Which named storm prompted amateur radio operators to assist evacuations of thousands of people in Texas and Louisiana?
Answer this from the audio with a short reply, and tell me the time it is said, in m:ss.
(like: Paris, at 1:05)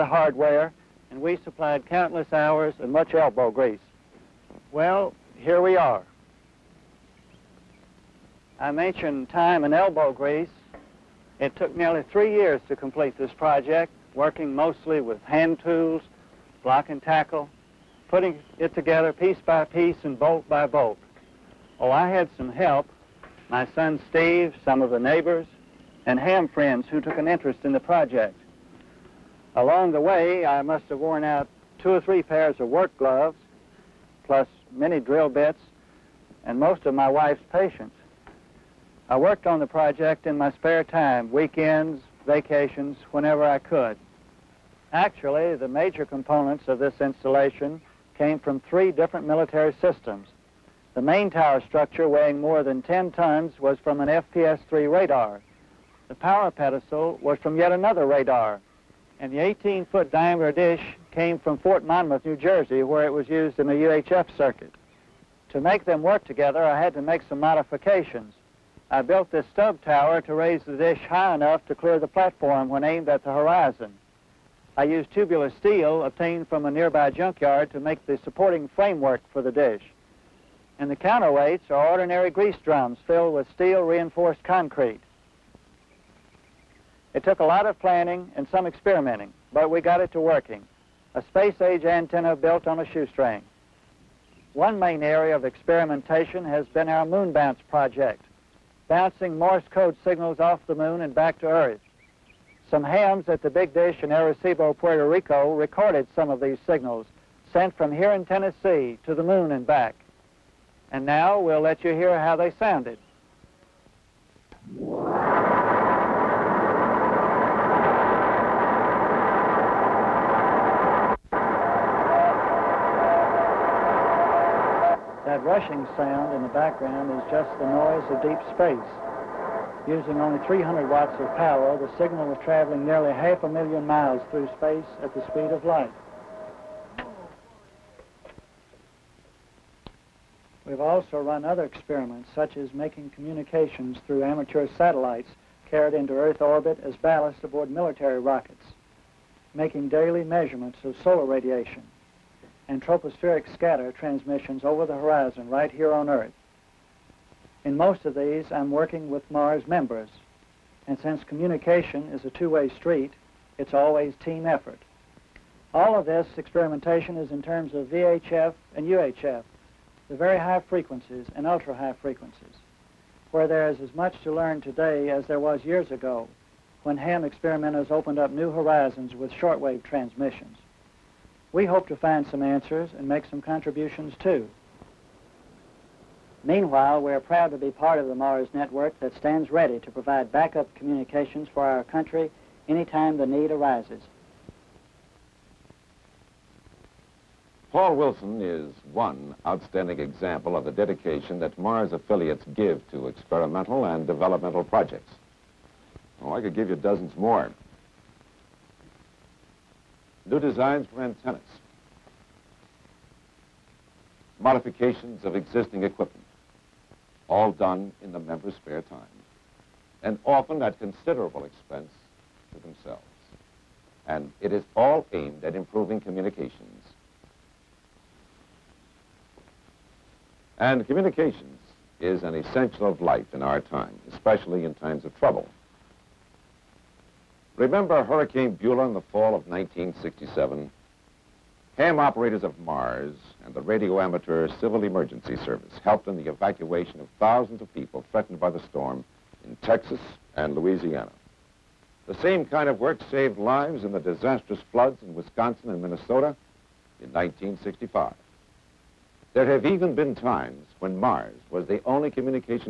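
Hurricane Beulah, at 3:58.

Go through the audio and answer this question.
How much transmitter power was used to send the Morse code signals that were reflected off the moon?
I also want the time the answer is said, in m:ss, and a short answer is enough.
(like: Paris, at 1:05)
300 watts, at 2:10.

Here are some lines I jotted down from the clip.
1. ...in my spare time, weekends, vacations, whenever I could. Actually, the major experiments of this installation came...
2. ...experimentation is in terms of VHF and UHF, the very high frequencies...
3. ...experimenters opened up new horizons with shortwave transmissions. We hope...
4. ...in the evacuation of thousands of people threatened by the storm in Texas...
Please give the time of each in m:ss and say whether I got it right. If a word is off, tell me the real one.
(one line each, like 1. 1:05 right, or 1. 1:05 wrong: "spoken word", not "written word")
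1. 0:40 wrong: "components", not "experiments"
2. 2:46 right
3. 2:57 right
4. 4:06 right.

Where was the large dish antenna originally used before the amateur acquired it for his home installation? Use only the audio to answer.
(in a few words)
Fort Monmouth, New Jersey.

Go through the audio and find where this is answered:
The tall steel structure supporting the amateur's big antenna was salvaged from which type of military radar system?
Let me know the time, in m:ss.
0:54.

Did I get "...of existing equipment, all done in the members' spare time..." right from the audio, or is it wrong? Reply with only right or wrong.
right.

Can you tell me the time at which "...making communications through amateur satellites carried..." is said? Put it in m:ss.
2:22.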